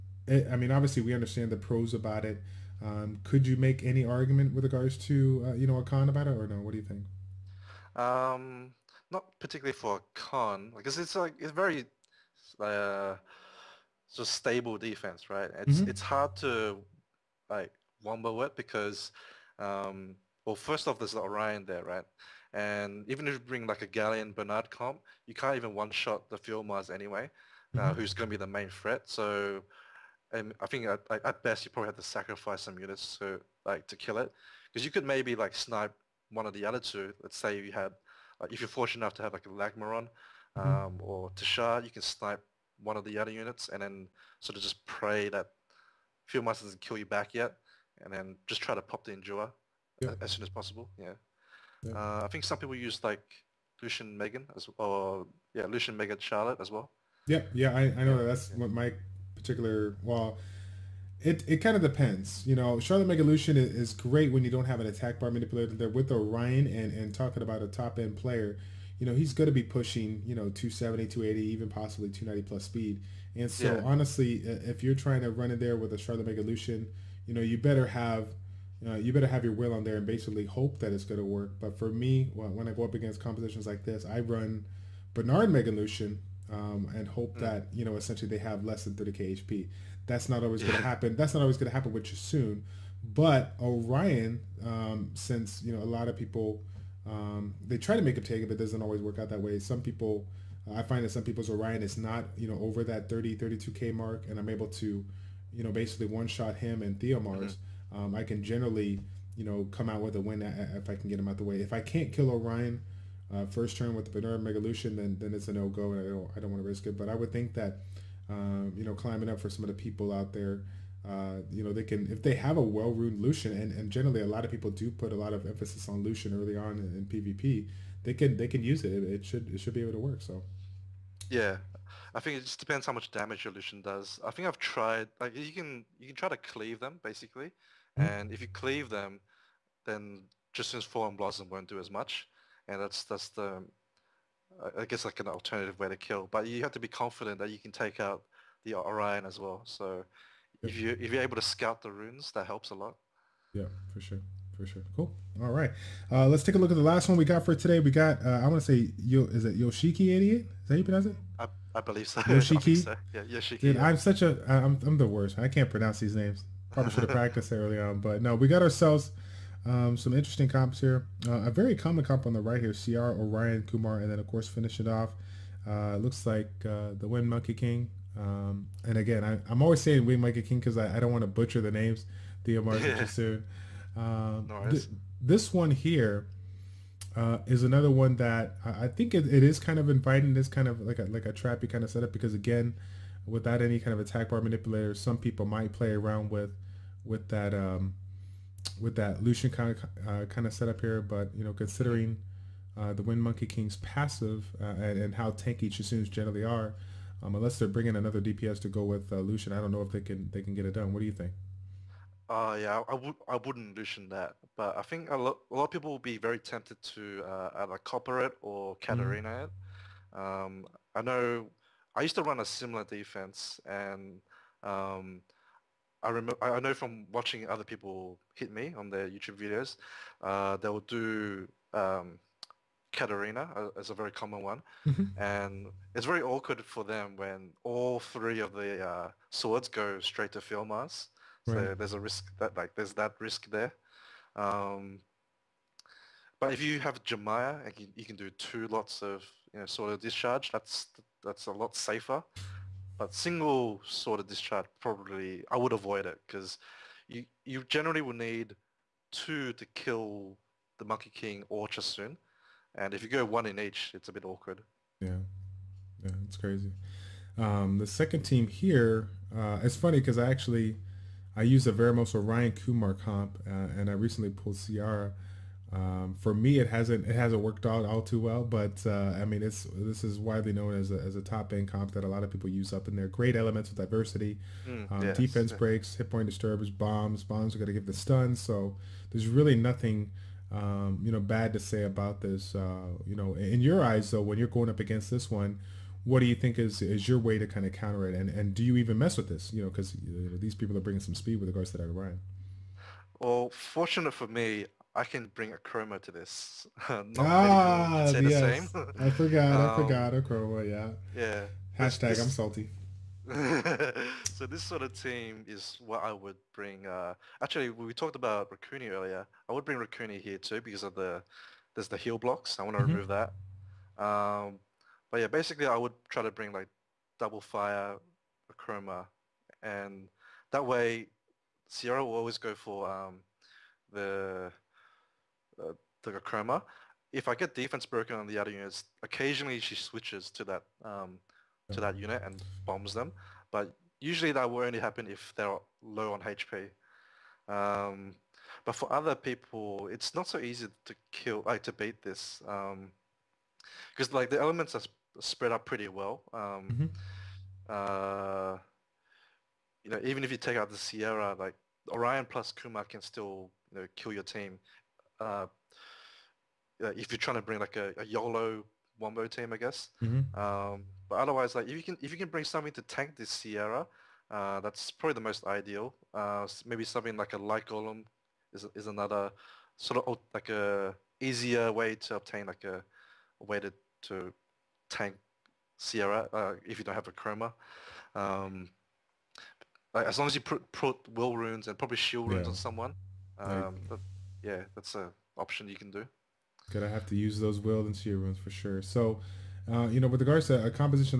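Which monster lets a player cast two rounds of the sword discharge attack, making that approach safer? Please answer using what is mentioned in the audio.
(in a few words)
Jemaya.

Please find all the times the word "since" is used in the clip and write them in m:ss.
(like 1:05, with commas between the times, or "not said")
1:35, 2:20.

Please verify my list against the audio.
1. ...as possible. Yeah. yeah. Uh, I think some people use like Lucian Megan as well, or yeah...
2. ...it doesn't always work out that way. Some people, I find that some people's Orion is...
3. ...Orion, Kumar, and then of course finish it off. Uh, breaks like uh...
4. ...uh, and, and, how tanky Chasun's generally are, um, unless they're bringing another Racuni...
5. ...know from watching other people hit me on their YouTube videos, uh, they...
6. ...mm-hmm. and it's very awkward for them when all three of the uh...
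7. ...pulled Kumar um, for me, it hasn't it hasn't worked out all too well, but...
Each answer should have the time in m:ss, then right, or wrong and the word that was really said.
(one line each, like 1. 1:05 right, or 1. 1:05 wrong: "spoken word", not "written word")
1. 0:50 right
2. 1:38 right
3. 2:53 wrong: "looks", not "breaks"
4. 3:24 wrong: "DPS", not "Racuni"
5. 3:46 right
6. 3:54 right
7. 4:34 wrong: "Ciara", not "Kumar".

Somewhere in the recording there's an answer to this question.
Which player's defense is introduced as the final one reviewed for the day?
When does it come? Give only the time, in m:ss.
2:39.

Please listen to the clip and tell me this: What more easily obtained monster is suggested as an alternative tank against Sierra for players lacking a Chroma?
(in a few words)
Light golem.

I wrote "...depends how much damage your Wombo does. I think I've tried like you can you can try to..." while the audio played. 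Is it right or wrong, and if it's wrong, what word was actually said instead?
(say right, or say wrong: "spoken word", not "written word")
wrong: "Lucian", not "Wombo".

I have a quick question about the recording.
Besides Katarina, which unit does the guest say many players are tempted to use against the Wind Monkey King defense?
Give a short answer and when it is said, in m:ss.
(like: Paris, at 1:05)
Copper, at 3:37.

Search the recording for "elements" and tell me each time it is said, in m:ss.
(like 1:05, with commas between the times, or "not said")
4:43, 5:54.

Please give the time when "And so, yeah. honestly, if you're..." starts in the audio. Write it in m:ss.
1:13.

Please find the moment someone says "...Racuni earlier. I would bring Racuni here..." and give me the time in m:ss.
5:18.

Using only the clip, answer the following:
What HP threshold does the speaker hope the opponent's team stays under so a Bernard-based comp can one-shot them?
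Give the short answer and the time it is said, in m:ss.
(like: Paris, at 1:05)
30k, at 1:28.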